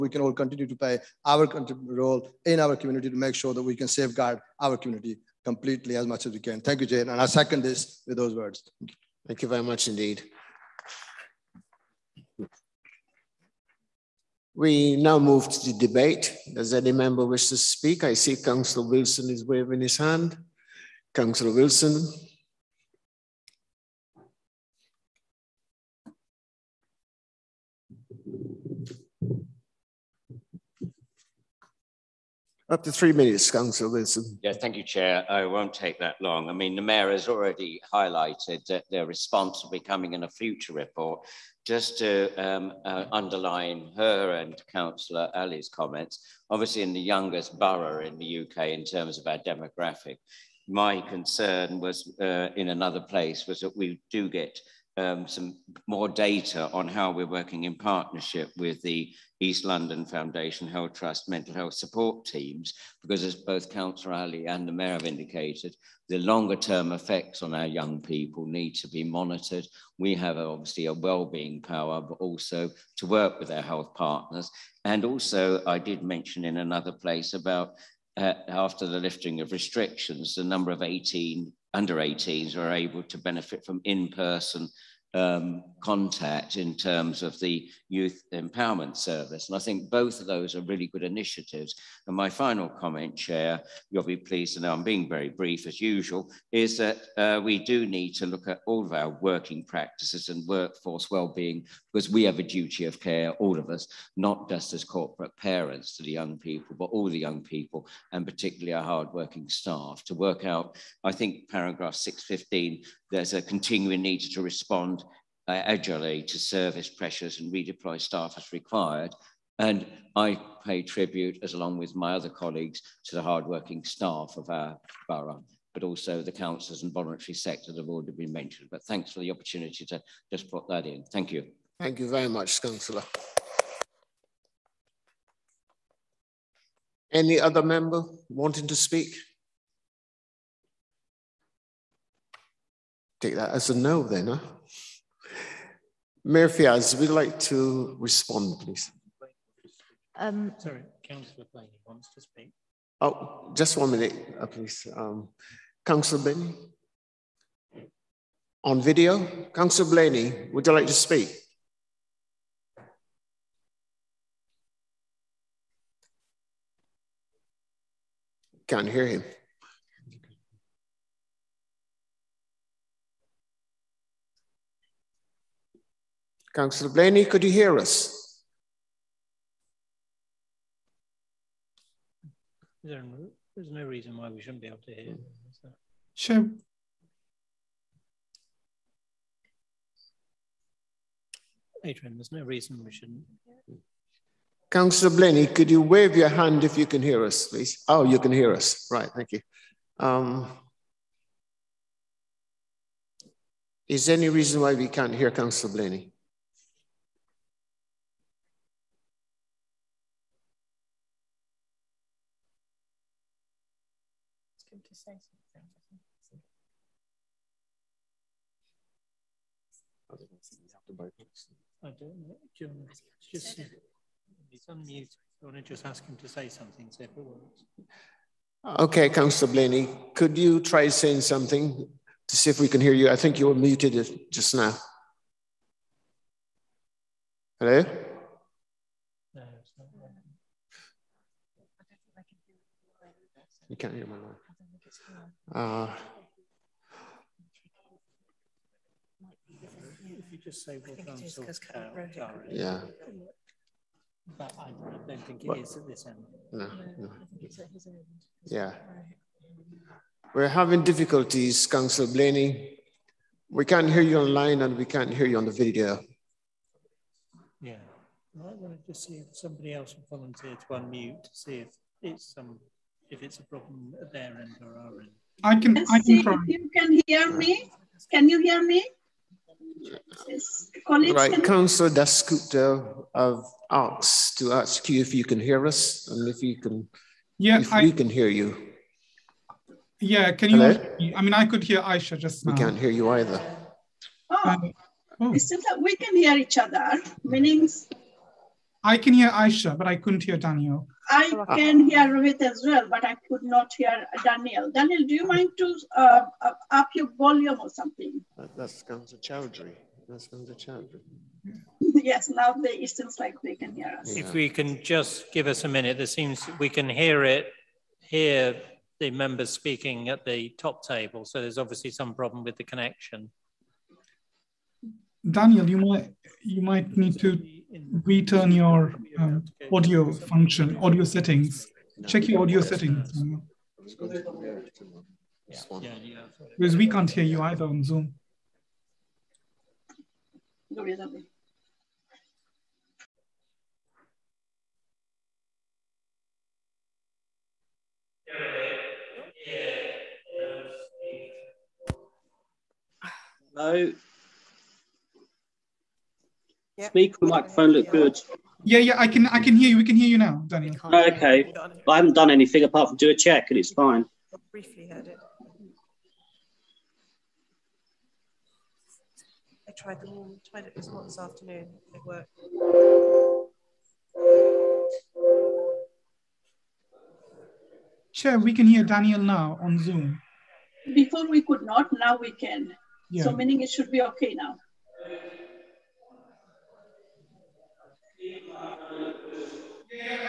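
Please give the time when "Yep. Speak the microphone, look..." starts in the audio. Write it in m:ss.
5:56.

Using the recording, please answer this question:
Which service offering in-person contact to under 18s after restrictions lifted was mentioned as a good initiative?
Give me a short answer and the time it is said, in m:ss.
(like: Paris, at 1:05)
Youth Empowerment Service, at 1:27.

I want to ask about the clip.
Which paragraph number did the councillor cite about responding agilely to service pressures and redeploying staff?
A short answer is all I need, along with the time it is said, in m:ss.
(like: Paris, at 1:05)
615, at 1:51.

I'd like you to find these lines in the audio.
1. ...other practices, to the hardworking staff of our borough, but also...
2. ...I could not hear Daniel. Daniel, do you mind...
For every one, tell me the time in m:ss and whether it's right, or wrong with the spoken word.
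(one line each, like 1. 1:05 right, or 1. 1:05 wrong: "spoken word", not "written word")
1. 2:02 wrong: "colleagues", not "practices"
2. 5:03 right.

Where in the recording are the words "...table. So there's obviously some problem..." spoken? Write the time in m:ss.
5:20.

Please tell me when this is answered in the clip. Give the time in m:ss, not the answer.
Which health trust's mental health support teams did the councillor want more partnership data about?
0:59.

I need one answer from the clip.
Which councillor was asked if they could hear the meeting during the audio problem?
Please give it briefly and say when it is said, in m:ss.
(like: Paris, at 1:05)
Councillor Dasgupta, at 4:41.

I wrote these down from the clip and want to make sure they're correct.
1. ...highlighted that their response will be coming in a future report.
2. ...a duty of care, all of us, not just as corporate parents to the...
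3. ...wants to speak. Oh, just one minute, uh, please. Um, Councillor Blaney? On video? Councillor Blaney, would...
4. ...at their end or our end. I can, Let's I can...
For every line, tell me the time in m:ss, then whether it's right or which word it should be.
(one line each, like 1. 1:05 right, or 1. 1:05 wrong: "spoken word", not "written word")
1. 0:37 right
2. 1:42 right
3. 2:31 right
4. 4:33 right.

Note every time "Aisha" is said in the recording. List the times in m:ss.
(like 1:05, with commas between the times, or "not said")
4:51, 4:59.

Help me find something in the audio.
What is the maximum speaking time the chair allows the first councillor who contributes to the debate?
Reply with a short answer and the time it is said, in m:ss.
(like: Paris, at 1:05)
3 minutes, at 0:32.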